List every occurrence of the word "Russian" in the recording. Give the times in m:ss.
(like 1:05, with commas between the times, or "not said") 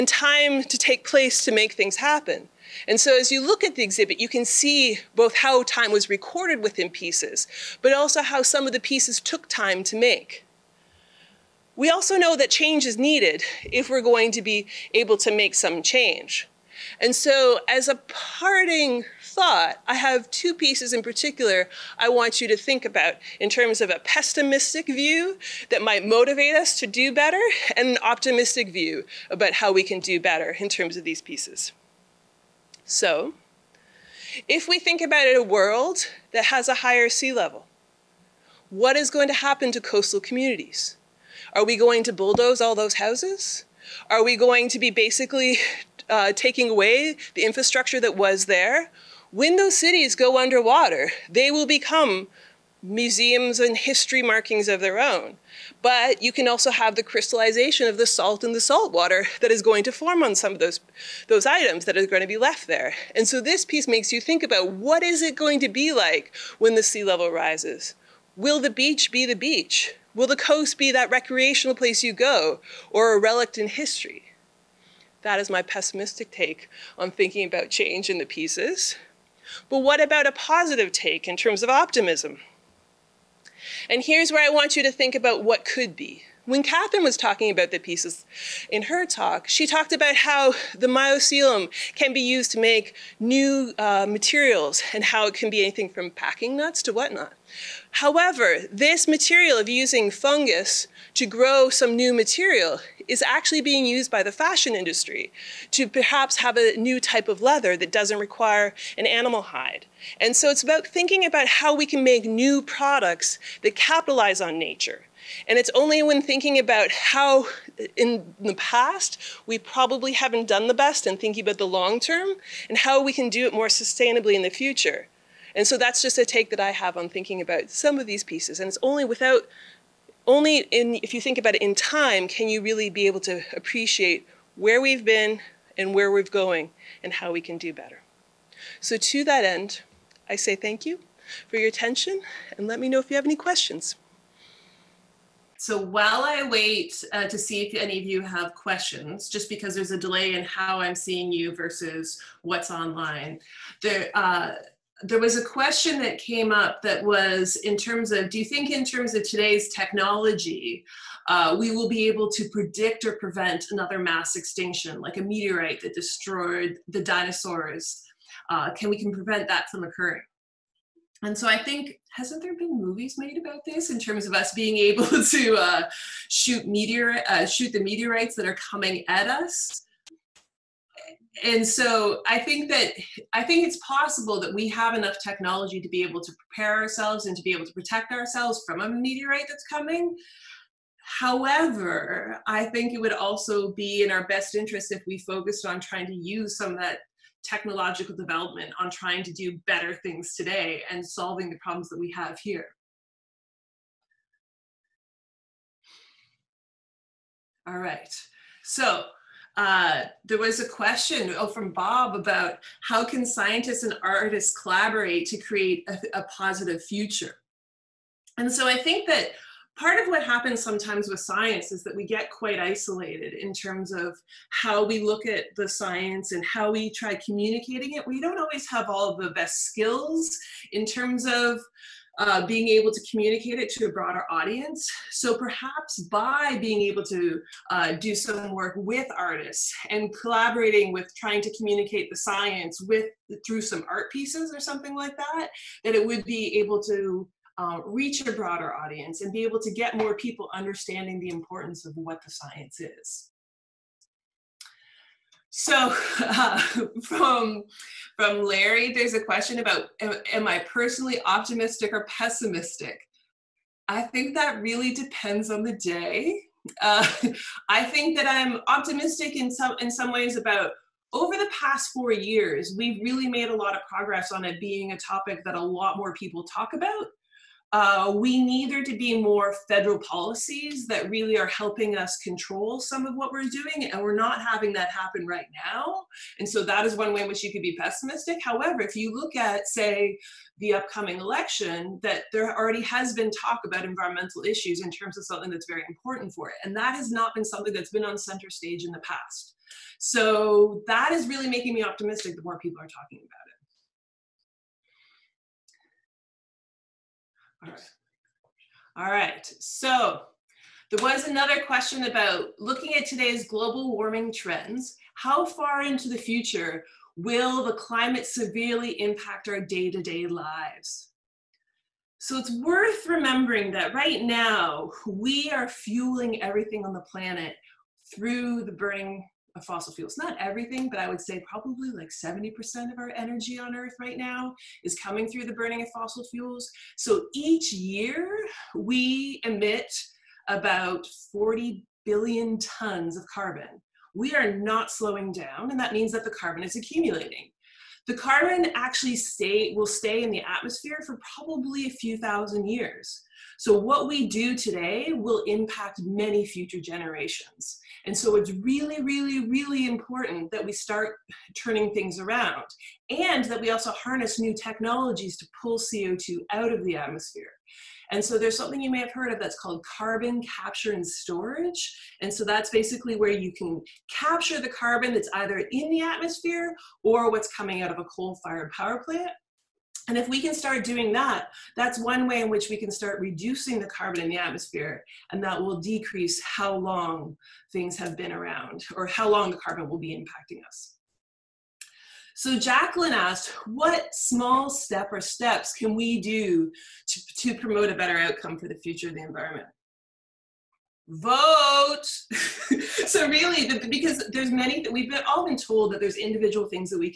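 not said.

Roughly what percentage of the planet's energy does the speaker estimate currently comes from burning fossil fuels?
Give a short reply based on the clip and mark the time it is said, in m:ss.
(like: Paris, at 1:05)
70%, at 5:32.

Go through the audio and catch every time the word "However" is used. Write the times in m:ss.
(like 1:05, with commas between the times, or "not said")
1:38, 3:11, 4:48.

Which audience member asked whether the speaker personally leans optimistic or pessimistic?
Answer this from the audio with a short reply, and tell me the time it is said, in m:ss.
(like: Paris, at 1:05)
Larry, at 4:18.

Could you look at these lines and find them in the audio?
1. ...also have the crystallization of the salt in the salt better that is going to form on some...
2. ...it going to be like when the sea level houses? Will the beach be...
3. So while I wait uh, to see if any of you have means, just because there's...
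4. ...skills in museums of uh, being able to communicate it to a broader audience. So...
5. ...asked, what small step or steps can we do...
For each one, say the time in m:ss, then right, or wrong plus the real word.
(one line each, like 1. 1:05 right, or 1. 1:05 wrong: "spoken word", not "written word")
1. 0:56 wrong: "water", not "better"
2. 1:05 wrong: "rises", not "houses"
3. 2:25 wrong: "questions", not "means"
4. 3:49 wrong: "terms", not "museums"
5. 6:33 right.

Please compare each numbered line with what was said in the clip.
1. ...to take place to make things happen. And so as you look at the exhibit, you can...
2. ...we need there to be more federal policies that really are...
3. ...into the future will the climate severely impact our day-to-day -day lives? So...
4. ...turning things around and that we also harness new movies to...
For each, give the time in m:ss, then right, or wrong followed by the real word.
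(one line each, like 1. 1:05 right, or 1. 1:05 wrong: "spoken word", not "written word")
1. 0:00 right
2. 4:38 right
3. 5:15 right
4. 6:01 wrong: "technologies", not "movies".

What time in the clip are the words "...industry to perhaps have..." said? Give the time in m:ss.
1:44.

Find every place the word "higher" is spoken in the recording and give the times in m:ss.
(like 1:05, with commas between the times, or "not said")
0:36.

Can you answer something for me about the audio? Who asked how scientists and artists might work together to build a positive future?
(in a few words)
Bob.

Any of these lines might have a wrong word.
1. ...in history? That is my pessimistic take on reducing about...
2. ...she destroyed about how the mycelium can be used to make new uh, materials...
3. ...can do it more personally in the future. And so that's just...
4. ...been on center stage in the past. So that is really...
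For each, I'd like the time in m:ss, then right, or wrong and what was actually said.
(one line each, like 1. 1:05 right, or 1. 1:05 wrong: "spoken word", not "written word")
1. 1:13 wrong: "thinking", not "reducing"
2. 1:29 wrong: "talked", not "destroyed"
3. 2:03 wrong: "sustainably", not "personally"
4. 4:57 right.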